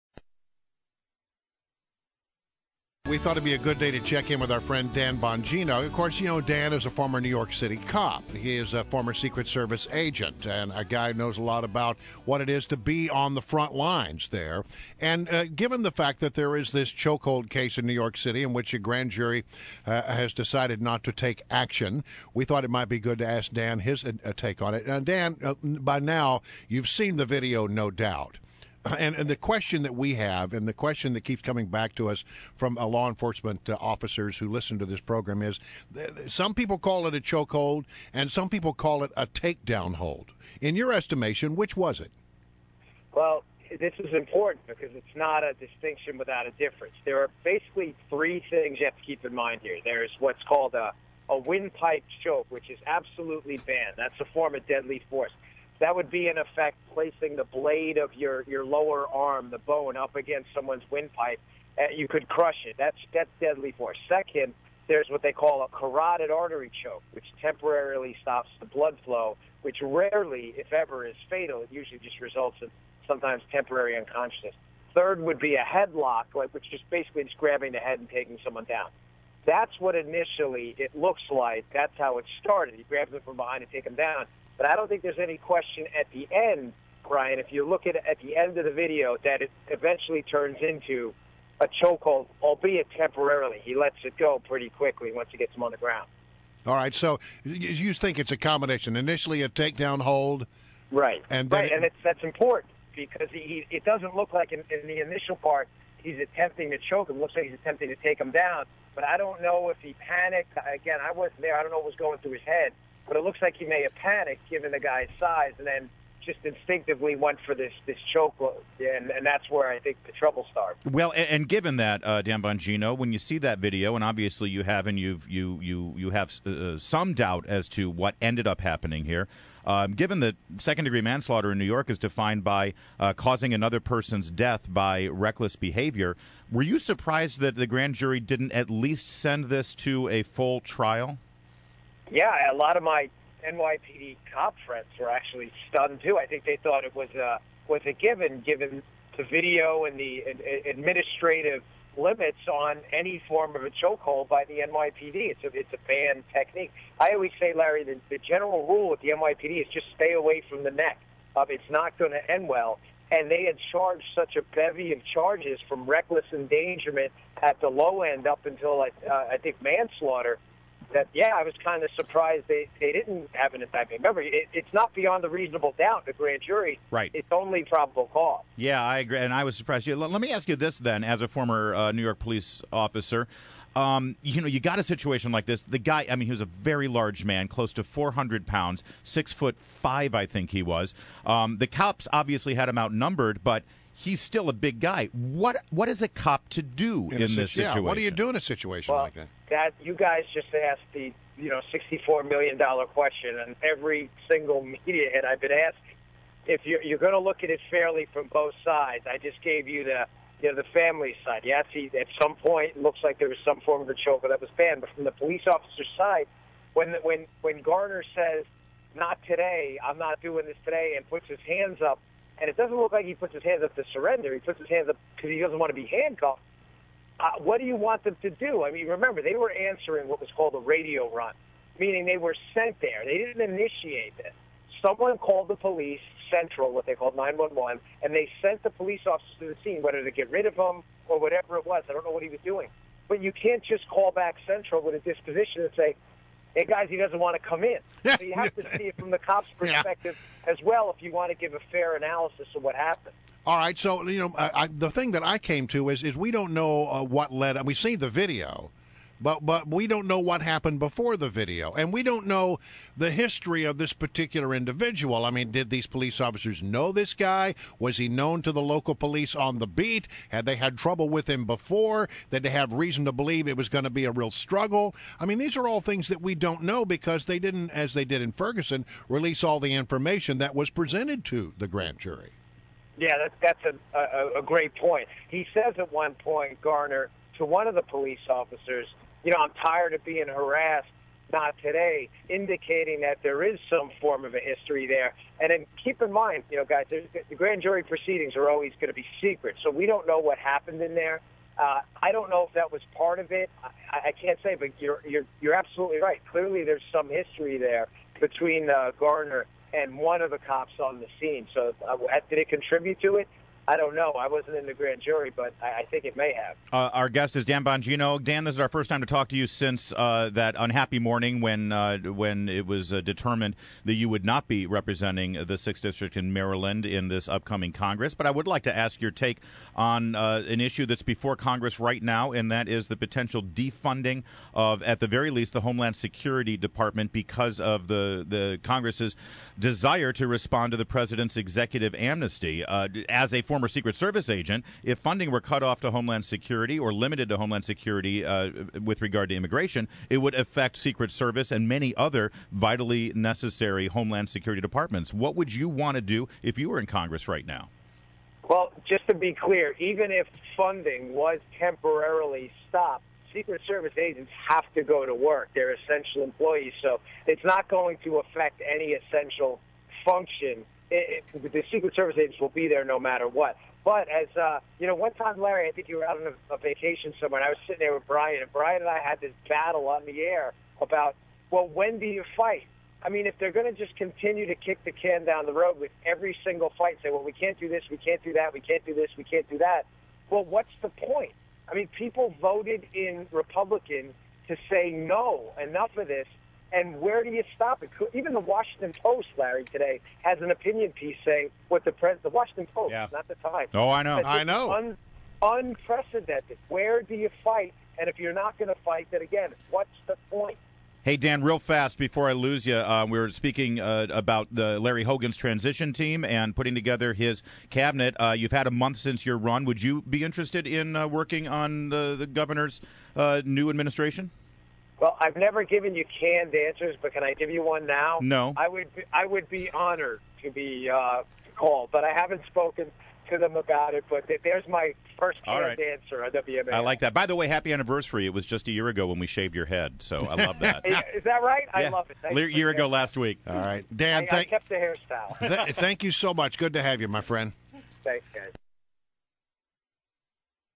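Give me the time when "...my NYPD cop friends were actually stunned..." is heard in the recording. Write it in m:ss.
2:22.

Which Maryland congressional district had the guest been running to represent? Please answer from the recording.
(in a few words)
sixth district.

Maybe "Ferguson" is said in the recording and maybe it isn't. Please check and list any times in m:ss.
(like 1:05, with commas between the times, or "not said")
4:38.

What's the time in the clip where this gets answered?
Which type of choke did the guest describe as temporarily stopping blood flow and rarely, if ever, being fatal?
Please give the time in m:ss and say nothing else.
1:05.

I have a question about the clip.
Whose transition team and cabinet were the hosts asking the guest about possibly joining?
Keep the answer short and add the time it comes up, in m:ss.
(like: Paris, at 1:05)
Larry Hogan, at 6:54.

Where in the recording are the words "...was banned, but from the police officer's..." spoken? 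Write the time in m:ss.
3:34.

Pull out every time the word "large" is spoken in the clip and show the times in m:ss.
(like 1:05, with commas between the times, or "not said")
3:06.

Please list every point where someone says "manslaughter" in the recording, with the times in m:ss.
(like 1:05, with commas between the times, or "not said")
2:11, 2:49.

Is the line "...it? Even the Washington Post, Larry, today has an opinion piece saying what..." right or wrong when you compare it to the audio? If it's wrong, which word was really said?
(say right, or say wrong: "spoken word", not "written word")
right.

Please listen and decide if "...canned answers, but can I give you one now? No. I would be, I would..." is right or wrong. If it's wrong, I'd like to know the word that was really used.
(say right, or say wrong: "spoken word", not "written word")
right.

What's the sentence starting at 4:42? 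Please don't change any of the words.
Yeah, that's that's a, a, a great point.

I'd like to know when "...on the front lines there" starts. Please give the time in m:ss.
0:13.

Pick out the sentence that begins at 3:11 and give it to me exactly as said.
Um, the cops obviously had him outnumbered, but he's still a big guy.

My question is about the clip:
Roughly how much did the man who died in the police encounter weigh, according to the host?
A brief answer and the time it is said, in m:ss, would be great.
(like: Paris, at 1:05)
close to 400 pounds, at 3:07.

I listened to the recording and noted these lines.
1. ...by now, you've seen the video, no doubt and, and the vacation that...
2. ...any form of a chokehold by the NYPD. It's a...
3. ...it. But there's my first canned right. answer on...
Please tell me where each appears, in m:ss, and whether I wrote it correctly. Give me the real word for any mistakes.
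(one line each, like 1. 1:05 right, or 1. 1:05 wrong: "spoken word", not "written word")
1. 0:25 wrong: "question", not "vacation"
2. 2:32 right
3. 7:13 right.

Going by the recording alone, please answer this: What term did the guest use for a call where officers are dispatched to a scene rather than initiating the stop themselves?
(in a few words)
radio run.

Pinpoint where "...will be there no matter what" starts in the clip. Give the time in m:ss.
6:12.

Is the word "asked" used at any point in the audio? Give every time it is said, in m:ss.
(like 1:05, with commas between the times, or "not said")
3:20, 3:25.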